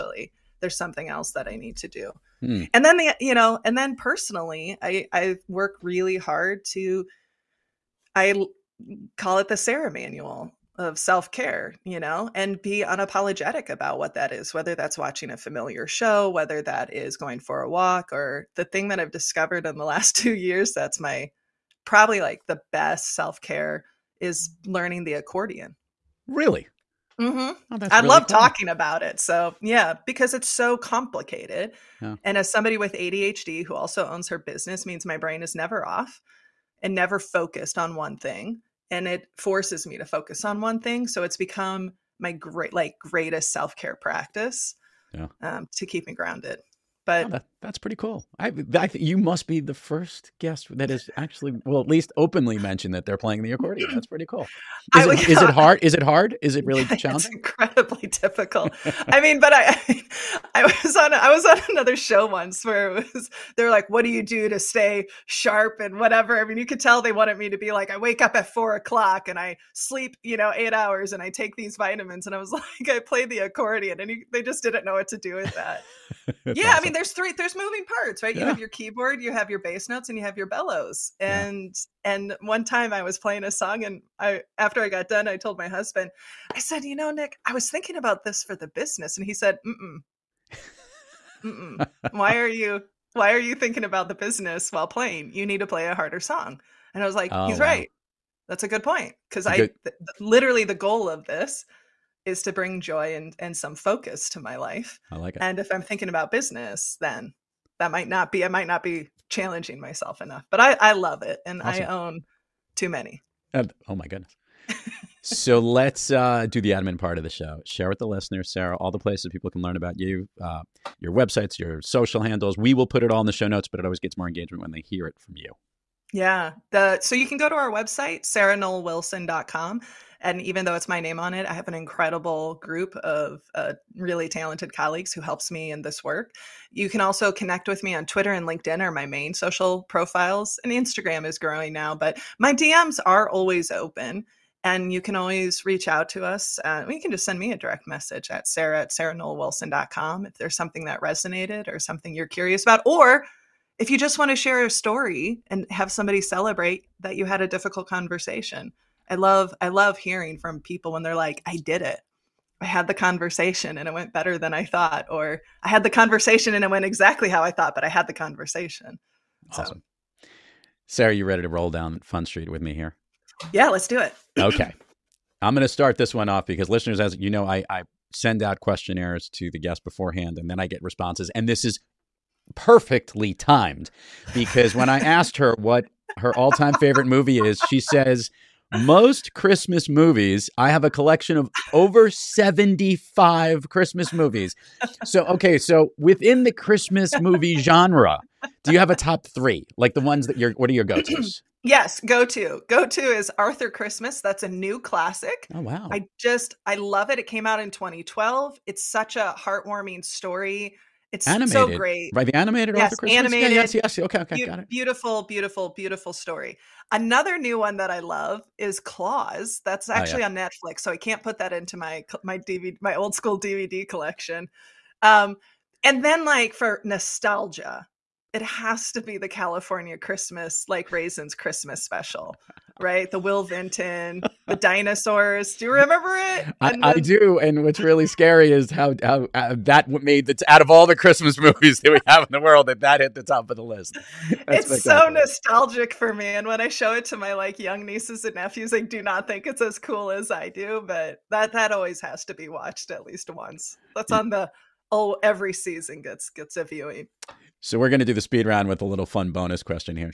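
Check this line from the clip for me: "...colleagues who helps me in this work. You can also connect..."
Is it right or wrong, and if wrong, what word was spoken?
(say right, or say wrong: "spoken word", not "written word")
right.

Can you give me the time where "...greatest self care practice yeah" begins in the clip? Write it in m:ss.
0:42.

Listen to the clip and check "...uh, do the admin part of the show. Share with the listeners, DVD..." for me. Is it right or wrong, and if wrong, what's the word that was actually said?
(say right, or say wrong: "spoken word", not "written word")
wrong: "Sarah", not "DVD".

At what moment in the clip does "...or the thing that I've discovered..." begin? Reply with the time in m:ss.
0:18.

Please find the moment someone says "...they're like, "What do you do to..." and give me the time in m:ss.
1:03.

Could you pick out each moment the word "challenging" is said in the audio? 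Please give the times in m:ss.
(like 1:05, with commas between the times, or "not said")
0:56, 1:49.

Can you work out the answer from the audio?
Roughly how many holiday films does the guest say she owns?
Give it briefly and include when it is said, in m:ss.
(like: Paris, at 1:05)
75, at 3:12.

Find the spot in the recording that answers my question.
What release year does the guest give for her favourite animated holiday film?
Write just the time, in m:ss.
3:27.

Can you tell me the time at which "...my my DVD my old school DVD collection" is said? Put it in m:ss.
3:41.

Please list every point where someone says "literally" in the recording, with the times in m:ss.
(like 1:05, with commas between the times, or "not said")
1:40.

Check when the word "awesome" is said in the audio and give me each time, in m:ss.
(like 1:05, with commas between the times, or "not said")
1:16, 1:51, 2:49.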